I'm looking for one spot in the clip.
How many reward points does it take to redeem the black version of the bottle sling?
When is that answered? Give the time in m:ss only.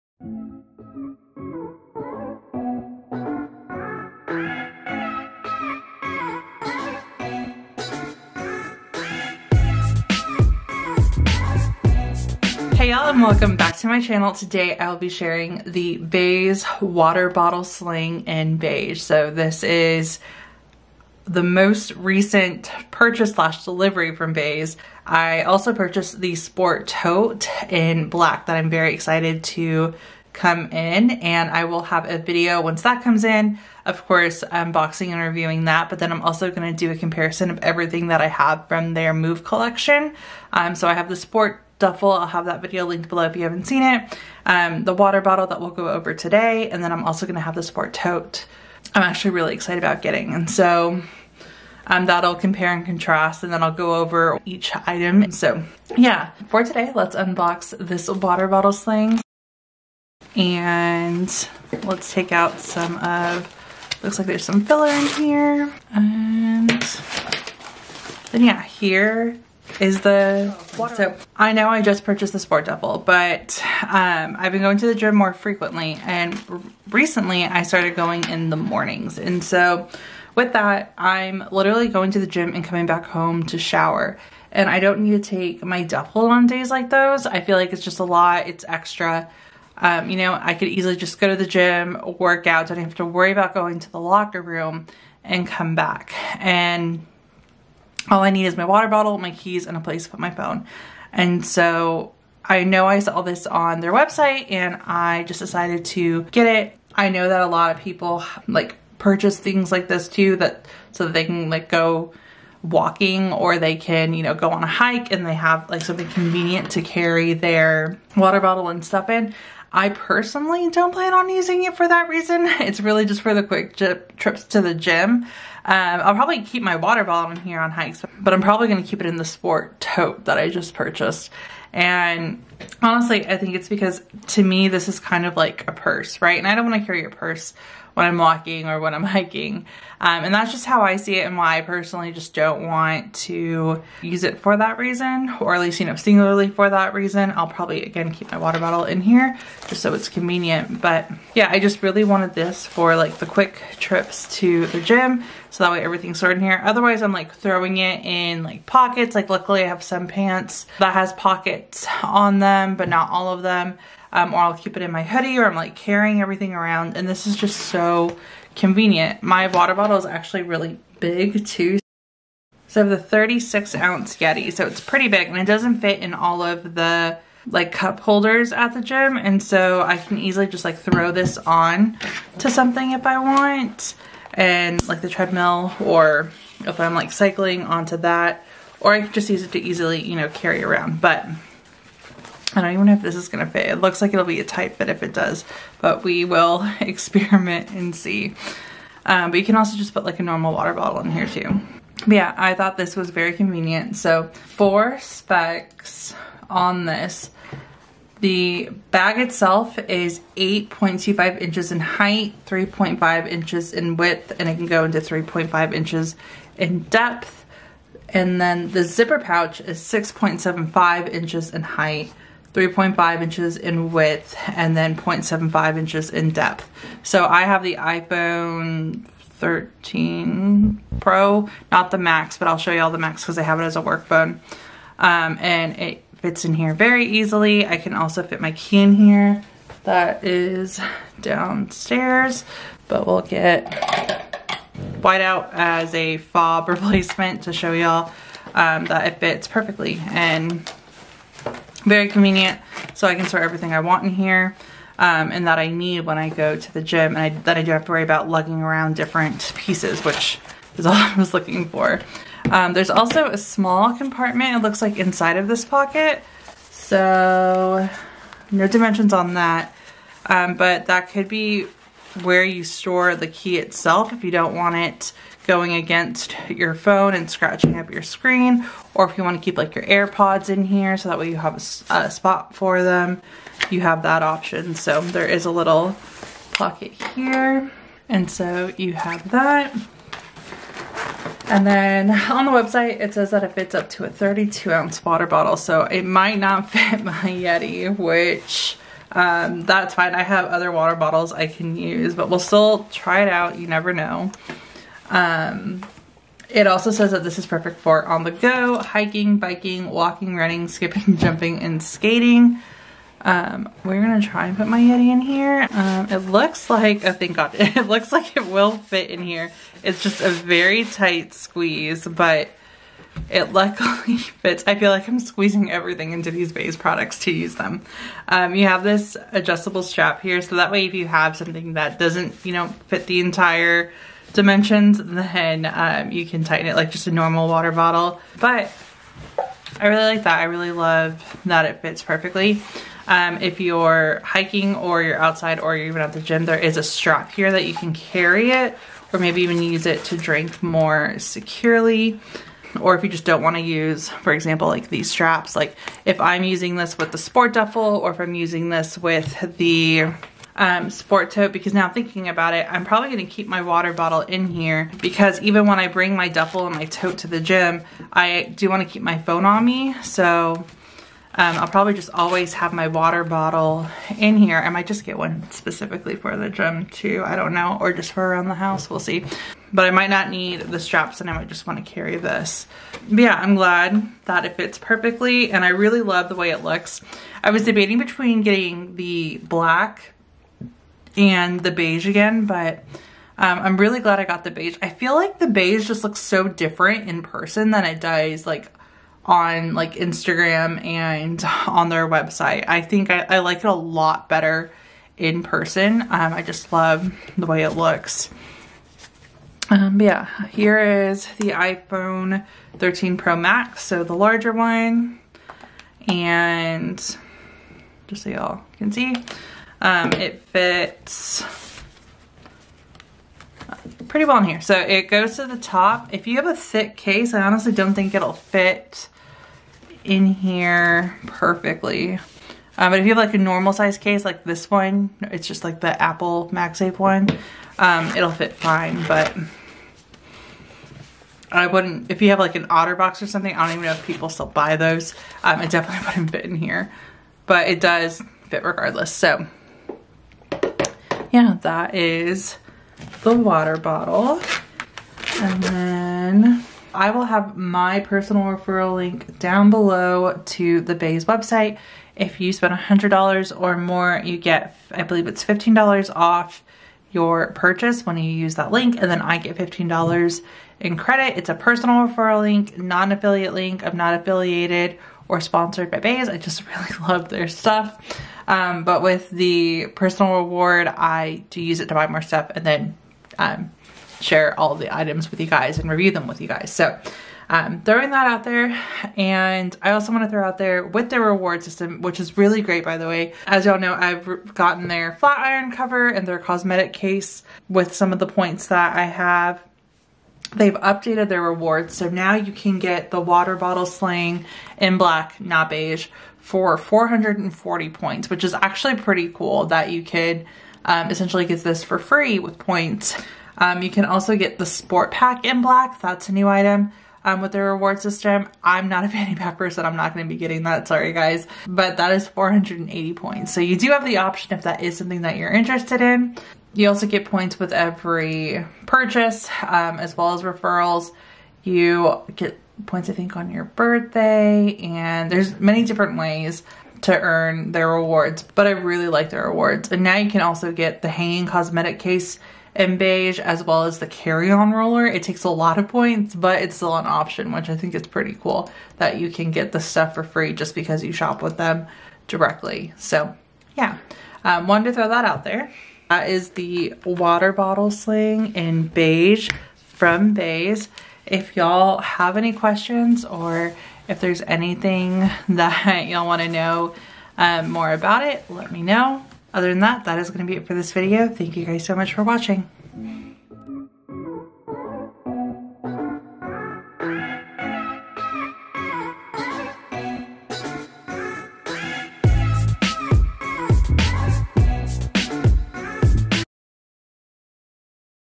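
8:26.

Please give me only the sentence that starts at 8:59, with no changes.
And now you can also get the hanging cosmetic case and beige as well as the carry-on roller.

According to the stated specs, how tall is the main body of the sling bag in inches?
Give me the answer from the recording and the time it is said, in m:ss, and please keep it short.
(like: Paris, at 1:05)
8.25 inches, at 3:30.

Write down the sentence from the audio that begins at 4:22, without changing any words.
Um, there's also a small compartment, it looks like inside of this pocket.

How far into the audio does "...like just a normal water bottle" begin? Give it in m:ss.
5:36.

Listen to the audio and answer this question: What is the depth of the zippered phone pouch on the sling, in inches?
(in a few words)
0.75 inches.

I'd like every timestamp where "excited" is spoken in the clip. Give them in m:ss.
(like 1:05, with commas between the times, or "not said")
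0:28, 0:49.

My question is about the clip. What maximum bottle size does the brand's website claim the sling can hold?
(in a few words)
32 ounces.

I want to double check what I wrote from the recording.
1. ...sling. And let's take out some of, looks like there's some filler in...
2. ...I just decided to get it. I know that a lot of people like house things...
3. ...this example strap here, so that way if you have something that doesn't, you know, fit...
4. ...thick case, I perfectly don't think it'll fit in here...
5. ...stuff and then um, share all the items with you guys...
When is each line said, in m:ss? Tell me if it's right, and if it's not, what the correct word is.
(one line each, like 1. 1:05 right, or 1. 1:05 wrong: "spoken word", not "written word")
1. 0:58 right
2. 1:44 wrong: "purchase", not "house"
3. 5:28 wrong: "adjustable", not "example"
4. 7:06 wrong: "honestly", not "perfectly"
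5. 8:02 right.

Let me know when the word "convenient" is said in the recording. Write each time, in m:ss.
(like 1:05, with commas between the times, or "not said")
1:56, 2:30, 2:48, 3:23, 4:12.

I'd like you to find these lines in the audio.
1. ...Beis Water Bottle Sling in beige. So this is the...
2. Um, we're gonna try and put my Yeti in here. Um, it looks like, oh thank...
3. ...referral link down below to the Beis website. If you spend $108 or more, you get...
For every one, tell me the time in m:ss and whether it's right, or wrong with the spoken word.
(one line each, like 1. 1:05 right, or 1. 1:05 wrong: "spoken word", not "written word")
1. 0:15 right
2. 5:13 right
3. 7:38 wrong: "100", not "108".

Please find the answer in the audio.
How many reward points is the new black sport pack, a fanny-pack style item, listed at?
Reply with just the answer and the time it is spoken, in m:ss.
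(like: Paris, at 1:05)
480, at 8:42.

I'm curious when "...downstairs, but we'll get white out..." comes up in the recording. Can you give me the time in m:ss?
4:01.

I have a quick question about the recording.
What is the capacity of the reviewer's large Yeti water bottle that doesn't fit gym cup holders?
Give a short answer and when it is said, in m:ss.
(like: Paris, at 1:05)
36 ounces, at 2:52.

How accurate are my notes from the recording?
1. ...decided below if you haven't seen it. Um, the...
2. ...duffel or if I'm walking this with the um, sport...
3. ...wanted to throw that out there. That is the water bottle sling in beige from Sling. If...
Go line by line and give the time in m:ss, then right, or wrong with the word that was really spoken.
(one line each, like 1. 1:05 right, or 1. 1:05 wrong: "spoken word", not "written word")
1. 0:42 wrong: "linked", not "decided"
2. 5:57 wrong: "using", not "walking"
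3. 9:14 wrong: "Beis", not "Sling".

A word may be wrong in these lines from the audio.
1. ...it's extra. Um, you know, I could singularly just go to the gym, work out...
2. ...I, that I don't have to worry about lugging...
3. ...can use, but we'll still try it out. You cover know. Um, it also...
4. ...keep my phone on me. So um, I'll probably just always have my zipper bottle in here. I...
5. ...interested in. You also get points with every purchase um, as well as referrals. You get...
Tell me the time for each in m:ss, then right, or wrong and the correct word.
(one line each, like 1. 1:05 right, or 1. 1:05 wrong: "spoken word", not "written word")
1. 1:28 wrong: "easily", not "singularly"
2. 4:17 right
3. 5:01 wrong: "never", not "cover"
4. 6:08 wrong: "water", not "zipper"
5. 8:45 right.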